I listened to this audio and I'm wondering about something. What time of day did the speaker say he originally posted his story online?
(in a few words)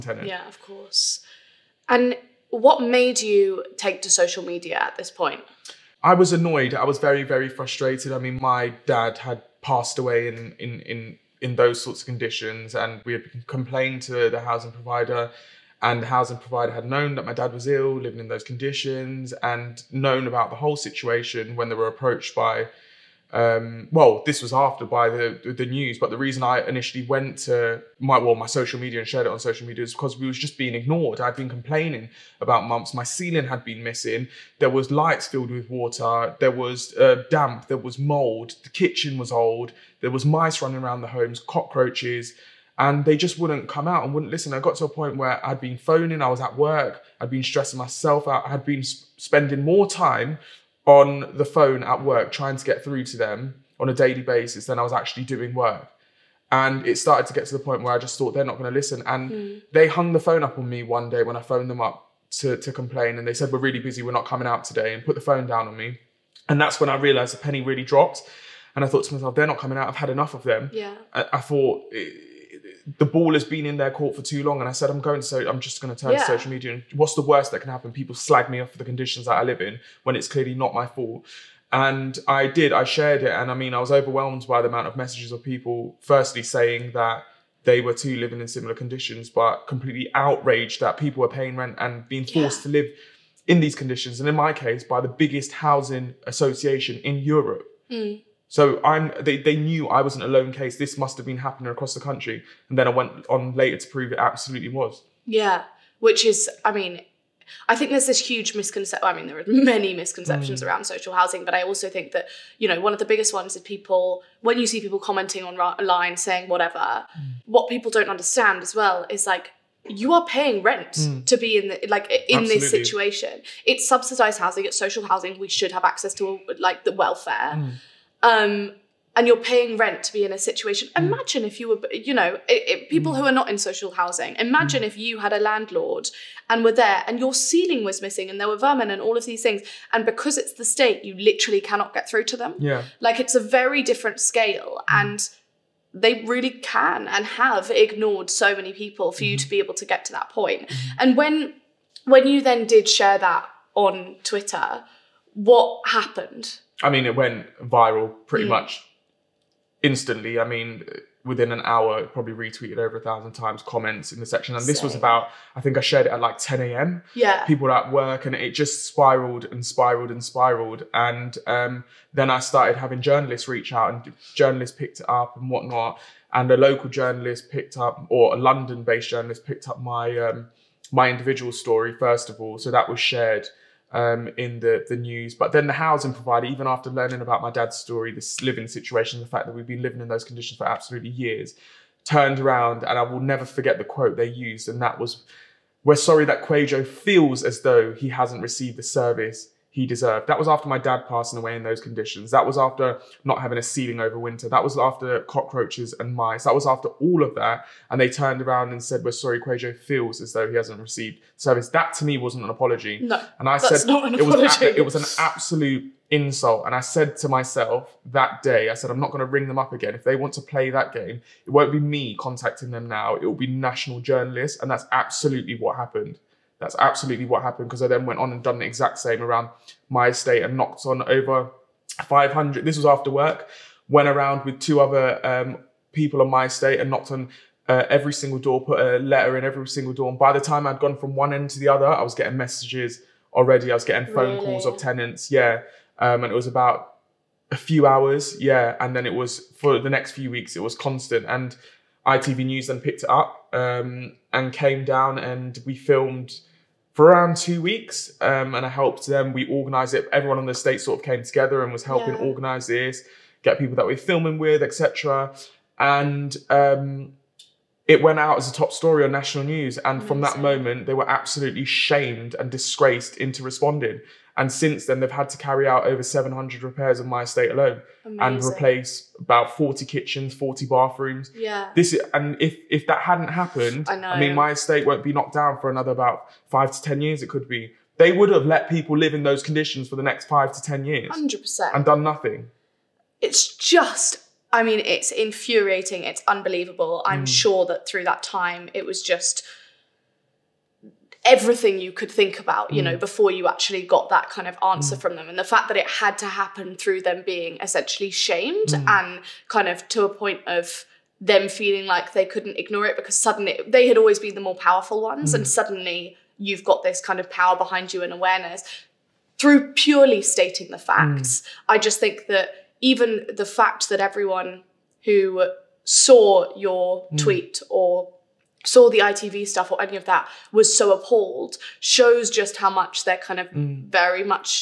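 10 a.m.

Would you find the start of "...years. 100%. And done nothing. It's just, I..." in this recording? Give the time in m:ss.
4:50.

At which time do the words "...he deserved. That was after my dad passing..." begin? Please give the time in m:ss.
3:19.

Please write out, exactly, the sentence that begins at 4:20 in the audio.
Everyone on the state sort of came together and was helping yeah.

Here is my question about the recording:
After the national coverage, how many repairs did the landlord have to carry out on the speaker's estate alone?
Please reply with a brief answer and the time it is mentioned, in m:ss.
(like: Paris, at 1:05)
700, at 4:35.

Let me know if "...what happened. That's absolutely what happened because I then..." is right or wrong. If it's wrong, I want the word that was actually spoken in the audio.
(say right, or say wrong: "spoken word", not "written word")
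right.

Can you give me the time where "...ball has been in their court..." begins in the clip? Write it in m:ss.
1:13.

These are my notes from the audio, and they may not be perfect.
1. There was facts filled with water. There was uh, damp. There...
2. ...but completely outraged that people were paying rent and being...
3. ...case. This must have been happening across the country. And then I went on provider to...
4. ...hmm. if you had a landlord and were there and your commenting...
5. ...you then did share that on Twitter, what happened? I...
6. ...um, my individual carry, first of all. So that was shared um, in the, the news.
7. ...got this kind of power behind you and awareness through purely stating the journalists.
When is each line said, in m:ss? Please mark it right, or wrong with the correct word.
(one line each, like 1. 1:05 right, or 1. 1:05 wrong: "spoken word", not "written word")
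1. 0:34 wrong: "lights", not "facts"
2. 1:29 right
3. 1:40 wrong: "later", not "provider"
4. 2:14 wrong: "ceiling", not "commenting"
5. 2:32 right
6. 3:00 wrong: "story", not "carry"
7. 5:16 wrong: "facts", not "journalists".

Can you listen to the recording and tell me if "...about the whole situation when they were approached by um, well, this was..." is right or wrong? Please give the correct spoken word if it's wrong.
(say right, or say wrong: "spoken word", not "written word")
right.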